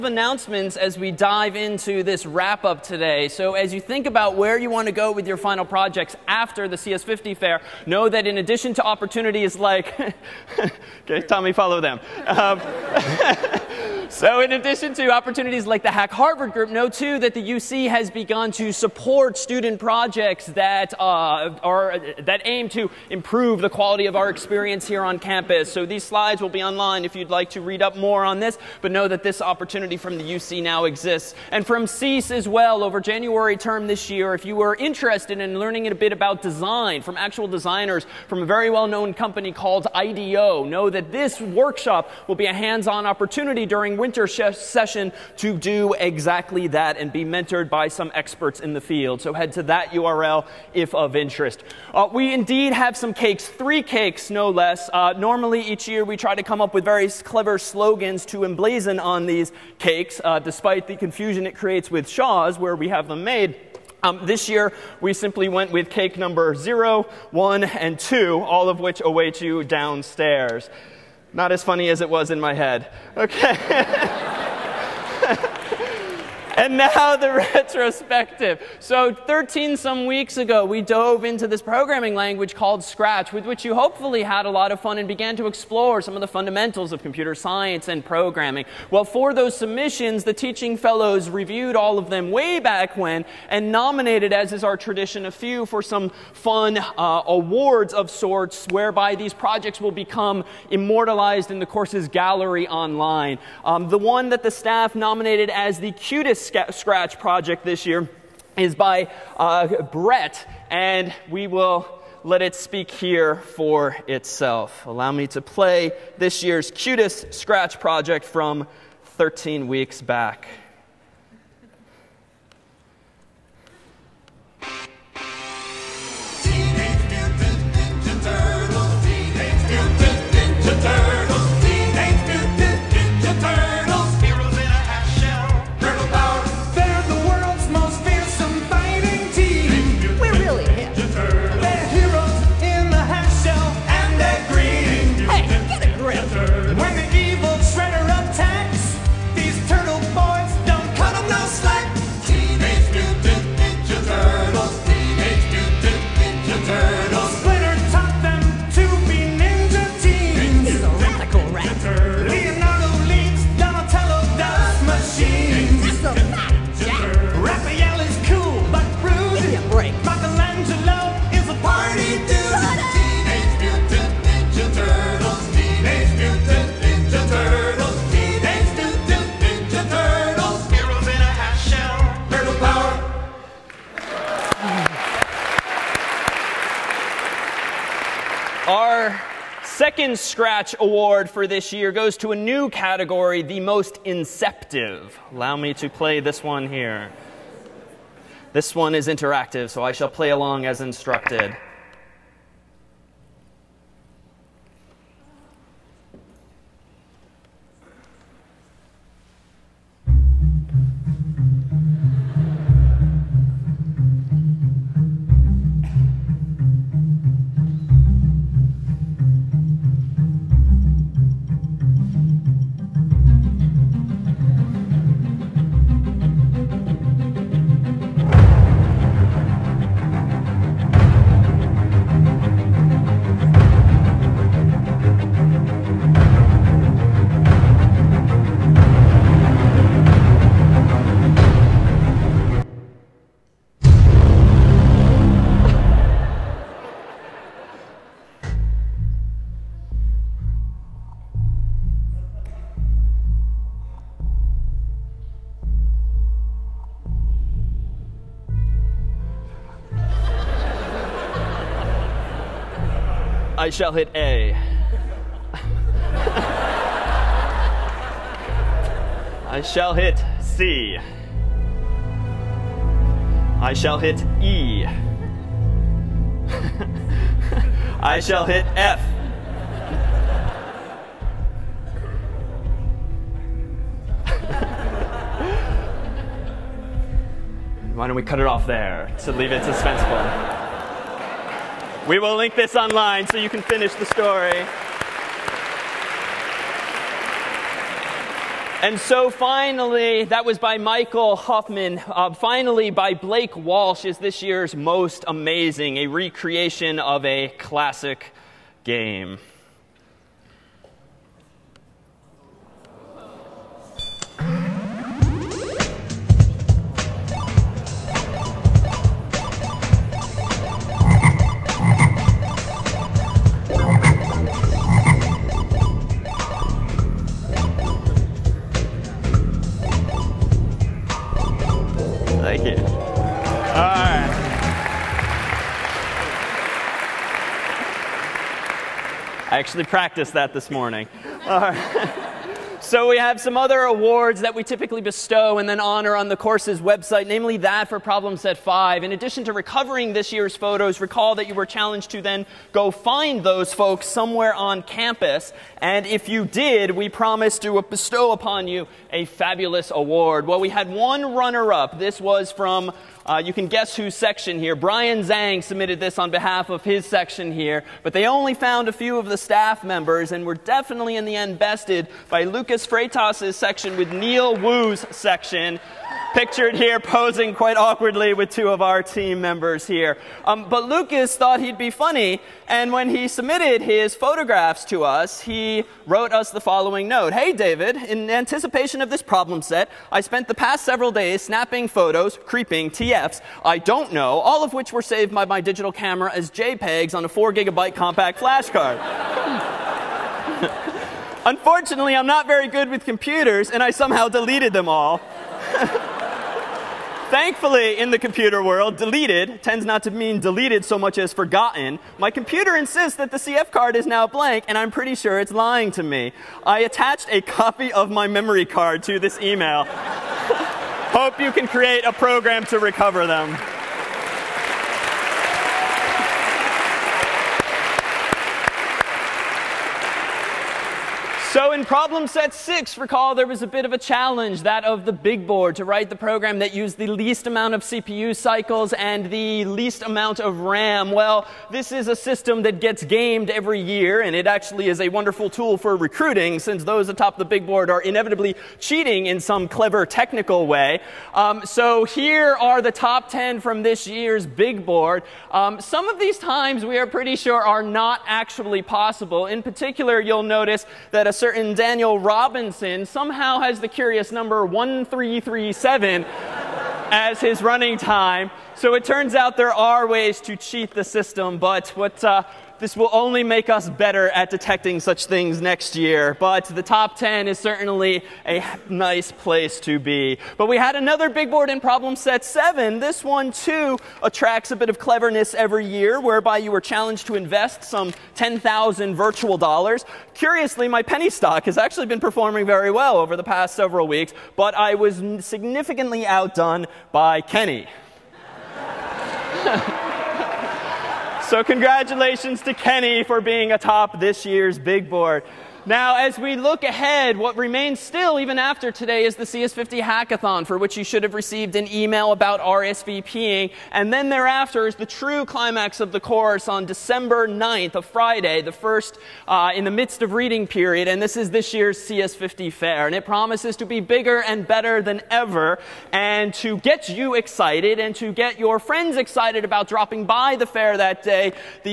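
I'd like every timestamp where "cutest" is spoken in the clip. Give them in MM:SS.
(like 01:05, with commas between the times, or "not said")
01:45, 01:56.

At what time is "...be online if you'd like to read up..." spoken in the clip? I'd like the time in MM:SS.
00:26.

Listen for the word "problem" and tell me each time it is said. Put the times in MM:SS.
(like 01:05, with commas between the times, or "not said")
05:48, 06:29, 07:11, 08:01.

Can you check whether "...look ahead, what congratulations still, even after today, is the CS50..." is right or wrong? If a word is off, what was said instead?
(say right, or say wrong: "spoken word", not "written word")
wrong: "remains", not "congratulations".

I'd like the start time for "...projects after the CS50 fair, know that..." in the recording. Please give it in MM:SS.
00:05.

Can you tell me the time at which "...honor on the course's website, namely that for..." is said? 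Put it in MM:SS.
05:45.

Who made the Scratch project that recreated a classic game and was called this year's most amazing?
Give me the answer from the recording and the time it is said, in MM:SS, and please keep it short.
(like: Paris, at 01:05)
Blake Walsh, at 05:03.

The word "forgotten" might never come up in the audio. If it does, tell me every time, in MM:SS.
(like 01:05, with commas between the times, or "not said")
06:51.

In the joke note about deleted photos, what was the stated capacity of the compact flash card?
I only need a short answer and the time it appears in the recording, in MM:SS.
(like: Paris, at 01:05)
4 gigabytes, at 06:37.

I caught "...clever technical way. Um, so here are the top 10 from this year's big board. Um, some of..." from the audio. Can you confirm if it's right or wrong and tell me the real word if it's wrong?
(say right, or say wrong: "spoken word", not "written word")
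right.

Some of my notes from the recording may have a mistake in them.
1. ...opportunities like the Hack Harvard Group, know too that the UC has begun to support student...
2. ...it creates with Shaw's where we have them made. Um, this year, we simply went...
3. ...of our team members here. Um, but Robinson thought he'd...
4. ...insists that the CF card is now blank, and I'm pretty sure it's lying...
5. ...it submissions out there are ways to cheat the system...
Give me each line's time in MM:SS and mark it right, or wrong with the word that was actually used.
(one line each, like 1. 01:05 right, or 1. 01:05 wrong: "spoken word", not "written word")
1. 00:15 right
2. 01:01 right
3. 06:18 wrong: "Lucas", not "Robinson"
4. 06:52 right
5. 07:48 wrong: "turns", not "submissions".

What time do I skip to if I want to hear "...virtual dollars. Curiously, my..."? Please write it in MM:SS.
08:09.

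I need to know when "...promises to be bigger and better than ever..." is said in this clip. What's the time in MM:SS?
08:43.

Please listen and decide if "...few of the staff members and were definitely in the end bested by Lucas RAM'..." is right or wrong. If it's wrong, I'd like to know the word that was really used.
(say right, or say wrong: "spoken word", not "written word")
wrong: "Freitas", not "RAM".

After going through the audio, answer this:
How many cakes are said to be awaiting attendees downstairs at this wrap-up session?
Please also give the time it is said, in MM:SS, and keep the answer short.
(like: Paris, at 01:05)
3, at 00:53.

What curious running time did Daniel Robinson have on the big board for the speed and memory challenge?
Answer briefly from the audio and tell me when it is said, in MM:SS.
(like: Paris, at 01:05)
1337, at 07:44.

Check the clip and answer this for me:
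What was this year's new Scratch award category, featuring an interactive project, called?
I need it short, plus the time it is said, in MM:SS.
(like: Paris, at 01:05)
most inceptive, at 03:13.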